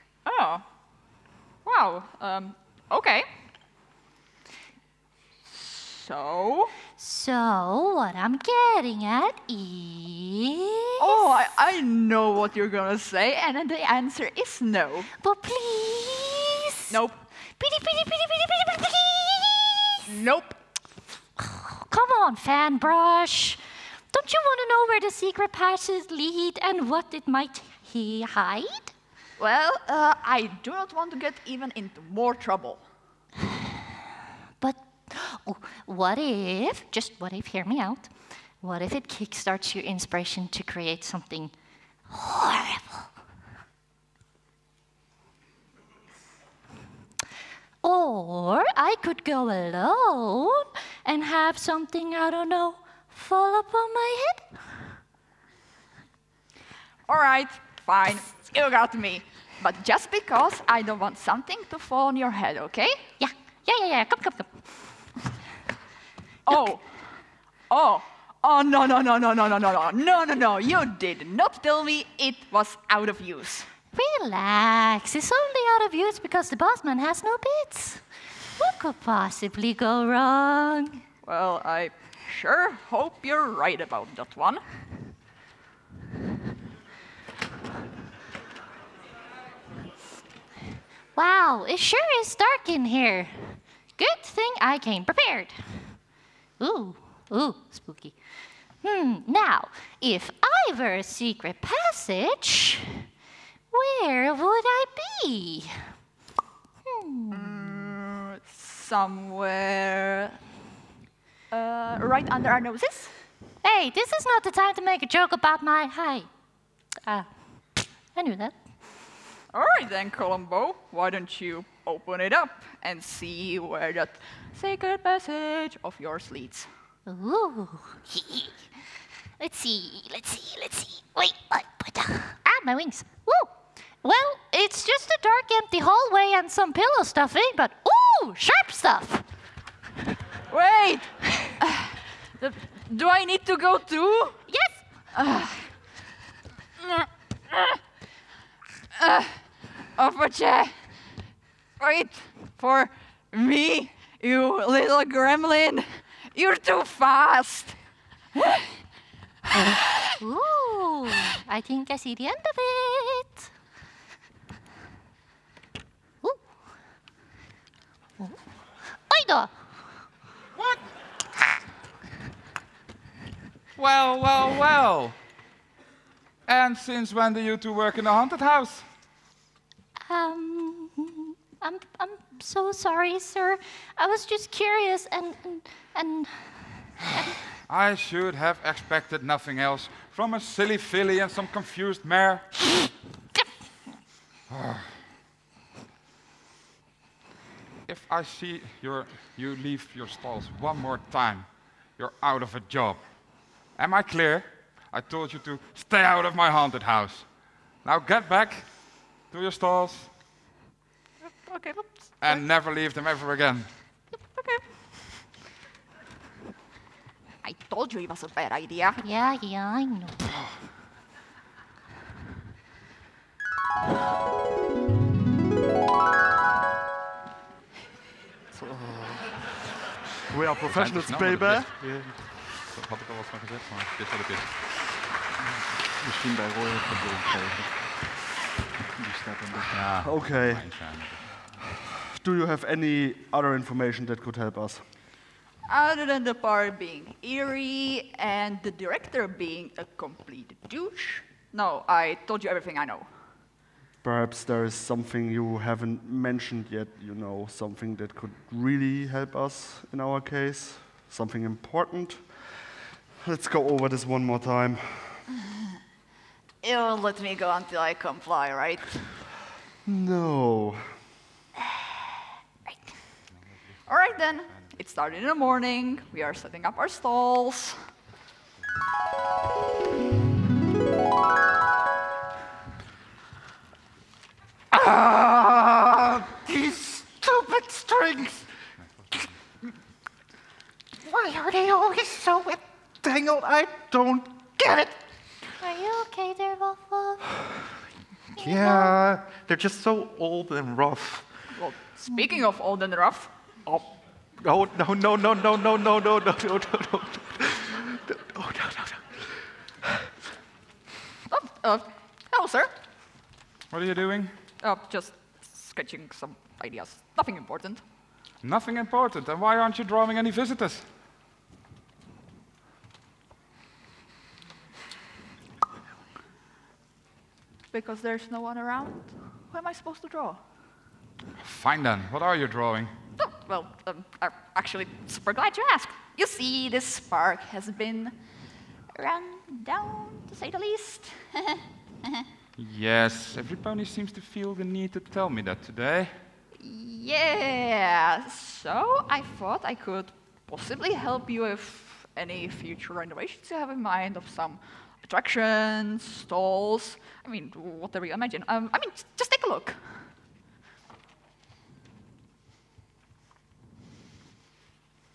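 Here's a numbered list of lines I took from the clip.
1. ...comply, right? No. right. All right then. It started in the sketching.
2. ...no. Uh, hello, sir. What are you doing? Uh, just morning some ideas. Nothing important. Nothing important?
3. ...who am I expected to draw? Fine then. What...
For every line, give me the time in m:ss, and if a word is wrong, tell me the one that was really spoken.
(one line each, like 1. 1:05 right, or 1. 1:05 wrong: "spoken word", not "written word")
1. 4:27 wrong: "morning", not "sketching"
2. 5:08 wrong: "sketching", not "morning"
3. 5:29 wrong: "supposed", not "expected".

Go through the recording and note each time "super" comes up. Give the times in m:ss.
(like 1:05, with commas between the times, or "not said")
5:35.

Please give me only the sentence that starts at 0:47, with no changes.
Or I could go alone and have something, I don't know, fall upon my head.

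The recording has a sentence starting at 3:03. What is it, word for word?
I was just curious and, and, and, and I should have expected nothing else from a silly filly and some confused mare.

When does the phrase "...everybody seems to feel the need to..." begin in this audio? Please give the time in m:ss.
5:43.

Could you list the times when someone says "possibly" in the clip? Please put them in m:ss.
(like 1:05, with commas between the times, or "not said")
1:18, 5:50.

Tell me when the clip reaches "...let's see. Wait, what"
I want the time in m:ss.
2:10.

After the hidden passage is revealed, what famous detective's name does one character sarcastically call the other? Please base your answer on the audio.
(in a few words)
Columbo.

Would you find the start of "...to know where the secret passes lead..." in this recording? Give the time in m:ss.
0:24.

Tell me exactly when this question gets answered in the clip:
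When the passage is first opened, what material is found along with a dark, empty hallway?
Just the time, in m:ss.
2:16.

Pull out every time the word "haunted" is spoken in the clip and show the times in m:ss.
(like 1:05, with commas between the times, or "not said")
2:58, 3:26.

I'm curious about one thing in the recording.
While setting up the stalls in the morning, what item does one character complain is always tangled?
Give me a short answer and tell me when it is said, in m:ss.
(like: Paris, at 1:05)
Strings, at 4:47.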